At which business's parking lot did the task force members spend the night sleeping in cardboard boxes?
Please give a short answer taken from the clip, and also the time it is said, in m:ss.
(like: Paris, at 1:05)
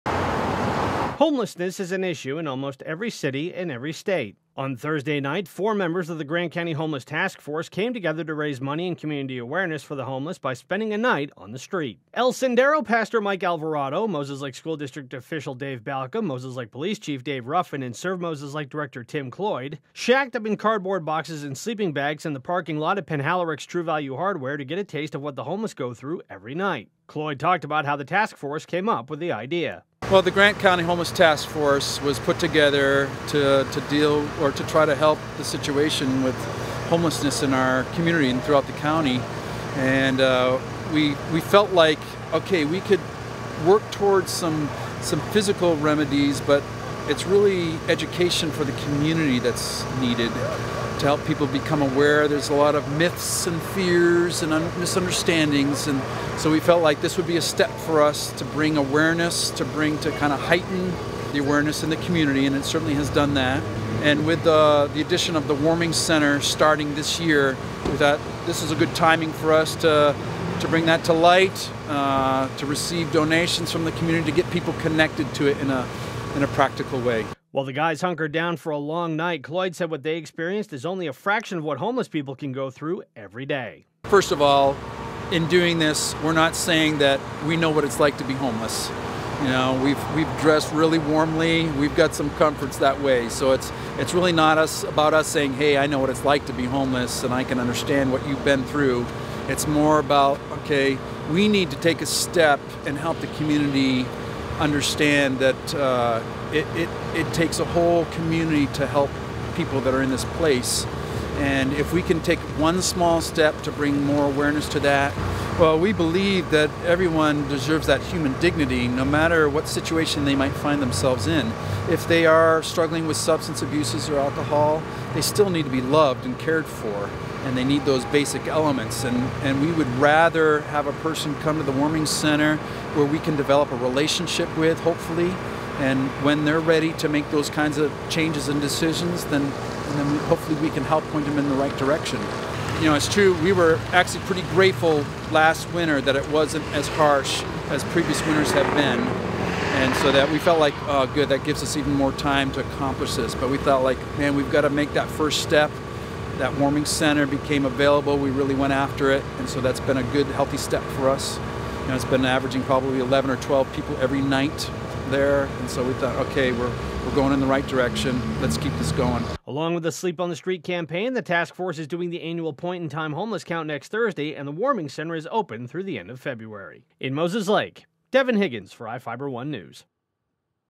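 Penhallurick's True Value Hardware, at 0:23.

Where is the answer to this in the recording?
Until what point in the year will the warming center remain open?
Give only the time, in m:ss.
2:55.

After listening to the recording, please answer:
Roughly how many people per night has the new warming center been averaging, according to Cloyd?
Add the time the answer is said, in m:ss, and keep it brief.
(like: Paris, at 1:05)
11 or 12, at 2:42.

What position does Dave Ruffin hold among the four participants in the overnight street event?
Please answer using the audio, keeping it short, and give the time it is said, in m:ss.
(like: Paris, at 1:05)
Police Chief, at 0:16.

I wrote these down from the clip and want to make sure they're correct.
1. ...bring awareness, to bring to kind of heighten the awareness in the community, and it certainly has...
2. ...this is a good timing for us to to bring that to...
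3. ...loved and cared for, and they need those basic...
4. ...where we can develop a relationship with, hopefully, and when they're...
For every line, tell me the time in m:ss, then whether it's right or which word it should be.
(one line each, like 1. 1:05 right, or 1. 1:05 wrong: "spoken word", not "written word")
1. 0:58 right
2. 1:08 right
3. 2:05 right
4. 2:12 right.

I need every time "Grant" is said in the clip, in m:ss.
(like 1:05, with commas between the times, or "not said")
0:06, 0:30.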